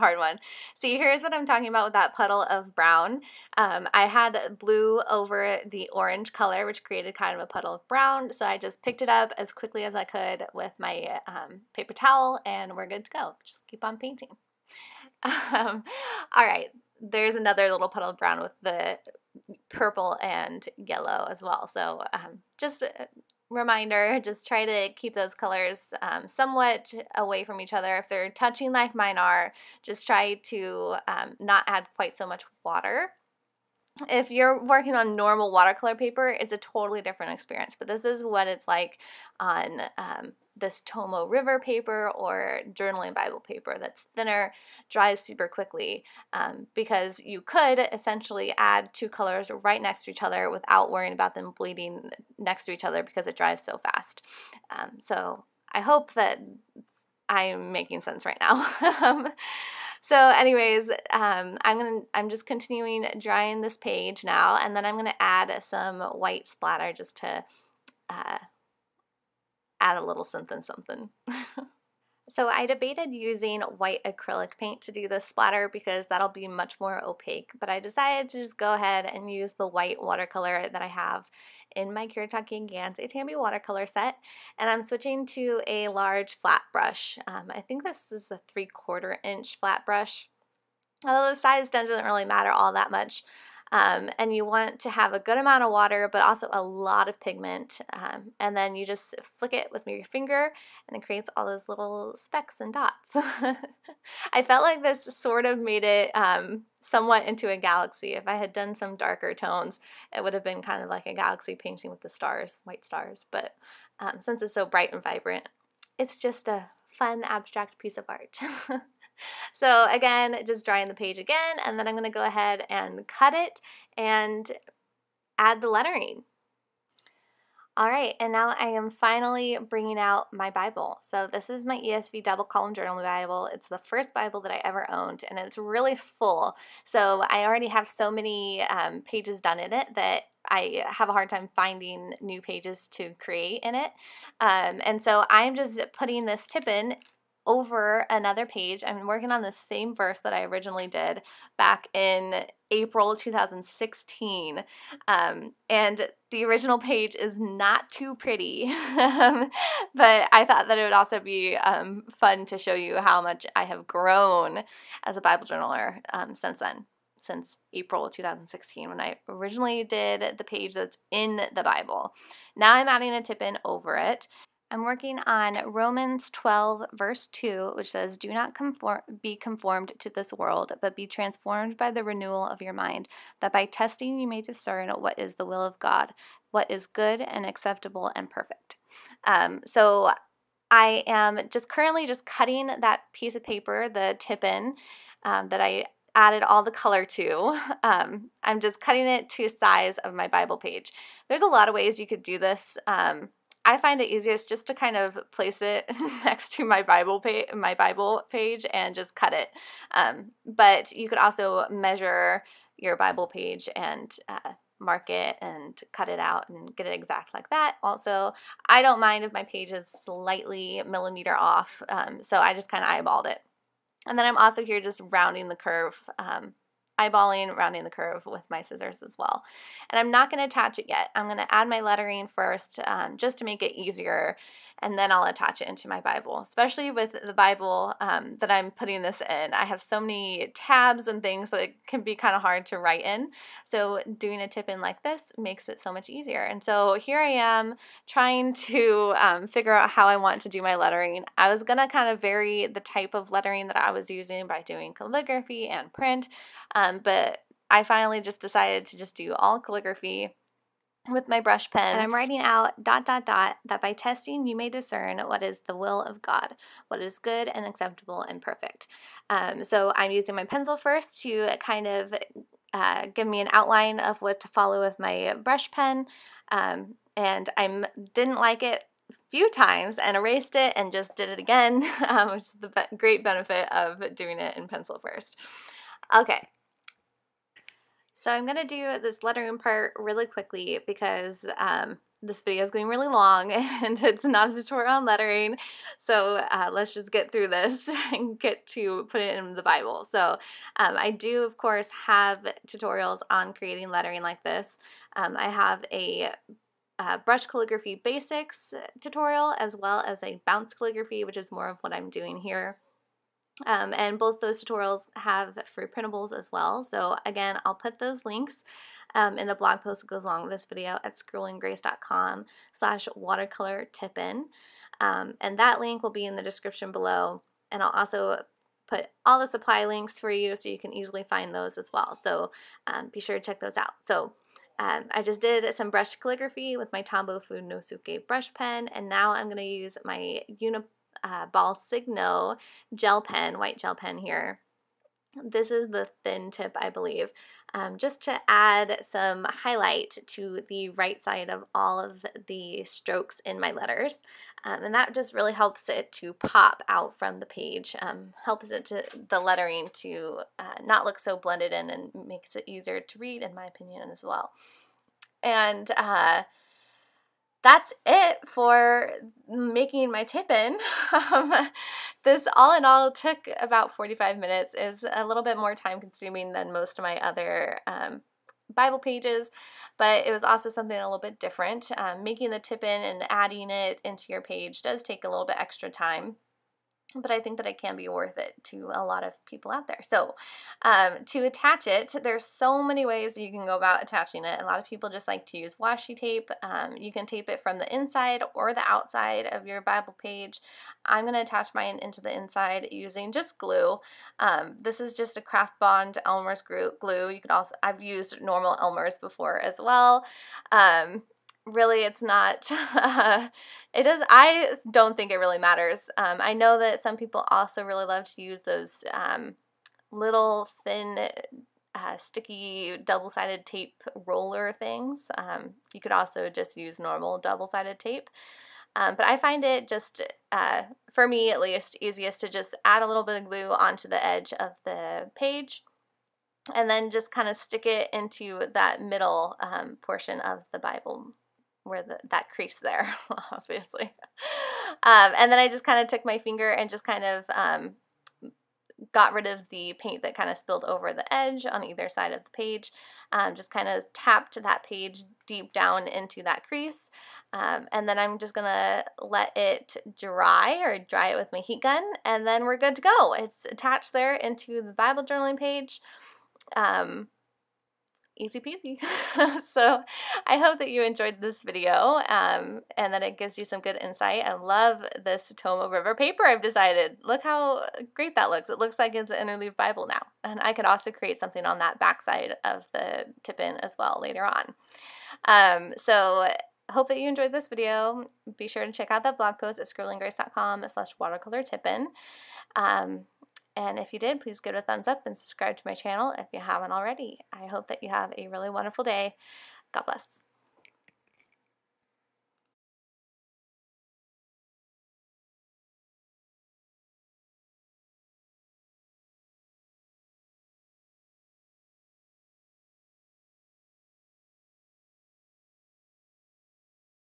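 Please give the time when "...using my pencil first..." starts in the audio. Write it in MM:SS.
04:30.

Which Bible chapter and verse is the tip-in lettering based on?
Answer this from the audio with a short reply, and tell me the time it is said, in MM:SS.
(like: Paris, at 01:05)
Romans 12:2, at 02:55.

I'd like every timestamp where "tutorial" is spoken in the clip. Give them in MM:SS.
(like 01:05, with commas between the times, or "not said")
04:54, 05:02, 05:08, 05:14.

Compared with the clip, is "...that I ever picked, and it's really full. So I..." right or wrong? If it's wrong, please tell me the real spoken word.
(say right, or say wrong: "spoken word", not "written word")
wrong: "owned", not "picked".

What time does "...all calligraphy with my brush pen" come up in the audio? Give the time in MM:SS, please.
04:19.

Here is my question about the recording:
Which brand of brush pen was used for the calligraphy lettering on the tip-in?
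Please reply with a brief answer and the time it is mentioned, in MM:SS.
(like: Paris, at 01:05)
Tombow Fudenosuke, at 05:37.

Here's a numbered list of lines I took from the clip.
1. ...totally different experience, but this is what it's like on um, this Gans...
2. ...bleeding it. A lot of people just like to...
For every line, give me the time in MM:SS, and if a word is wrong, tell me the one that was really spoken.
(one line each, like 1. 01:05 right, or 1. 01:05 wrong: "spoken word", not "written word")
1. 00:36 wrong: "Tomoe", not "Gans"
2. 06:34 wrong: "attaching", not "bleeding".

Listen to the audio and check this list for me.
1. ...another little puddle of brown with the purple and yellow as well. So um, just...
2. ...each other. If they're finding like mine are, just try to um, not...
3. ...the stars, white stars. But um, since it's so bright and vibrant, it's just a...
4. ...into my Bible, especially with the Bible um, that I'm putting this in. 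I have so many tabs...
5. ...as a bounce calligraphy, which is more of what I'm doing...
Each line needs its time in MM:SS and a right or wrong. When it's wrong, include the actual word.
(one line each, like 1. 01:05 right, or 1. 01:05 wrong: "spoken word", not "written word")
1. 00:17 right
2. 00:27 wrong: "touching", not "finding"
3. 01:52 right
4. 03:55 right
5. 05:10 right.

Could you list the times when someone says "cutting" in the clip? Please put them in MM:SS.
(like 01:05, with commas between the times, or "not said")
03:12, 03:18.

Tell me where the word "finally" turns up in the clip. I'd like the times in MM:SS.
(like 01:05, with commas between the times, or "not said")
02:08, 04:17.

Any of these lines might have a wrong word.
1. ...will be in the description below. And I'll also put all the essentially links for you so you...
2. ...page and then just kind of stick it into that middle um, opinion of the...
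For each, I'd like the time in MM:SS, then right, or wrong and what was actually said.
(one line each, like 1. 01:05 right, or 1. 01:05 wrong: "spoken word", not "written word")
1. 05:26 wrong: "supply", not "essentially"
2. 07:15 wrong: "portion", not "opinion".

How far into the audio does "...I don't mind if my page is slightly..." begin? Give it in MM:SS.
03:38.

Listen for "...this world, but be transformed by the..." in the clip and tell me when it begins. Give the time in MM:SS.
03:00.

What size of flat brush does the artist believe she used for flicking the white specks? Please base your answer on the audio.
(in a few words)
three quarter inch.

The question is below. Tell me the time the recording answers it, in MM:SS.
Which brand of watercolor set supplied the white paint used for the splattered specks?
01:22.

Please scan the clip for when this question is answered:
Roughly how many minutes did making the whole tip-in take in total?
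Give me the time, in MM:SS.
06:13.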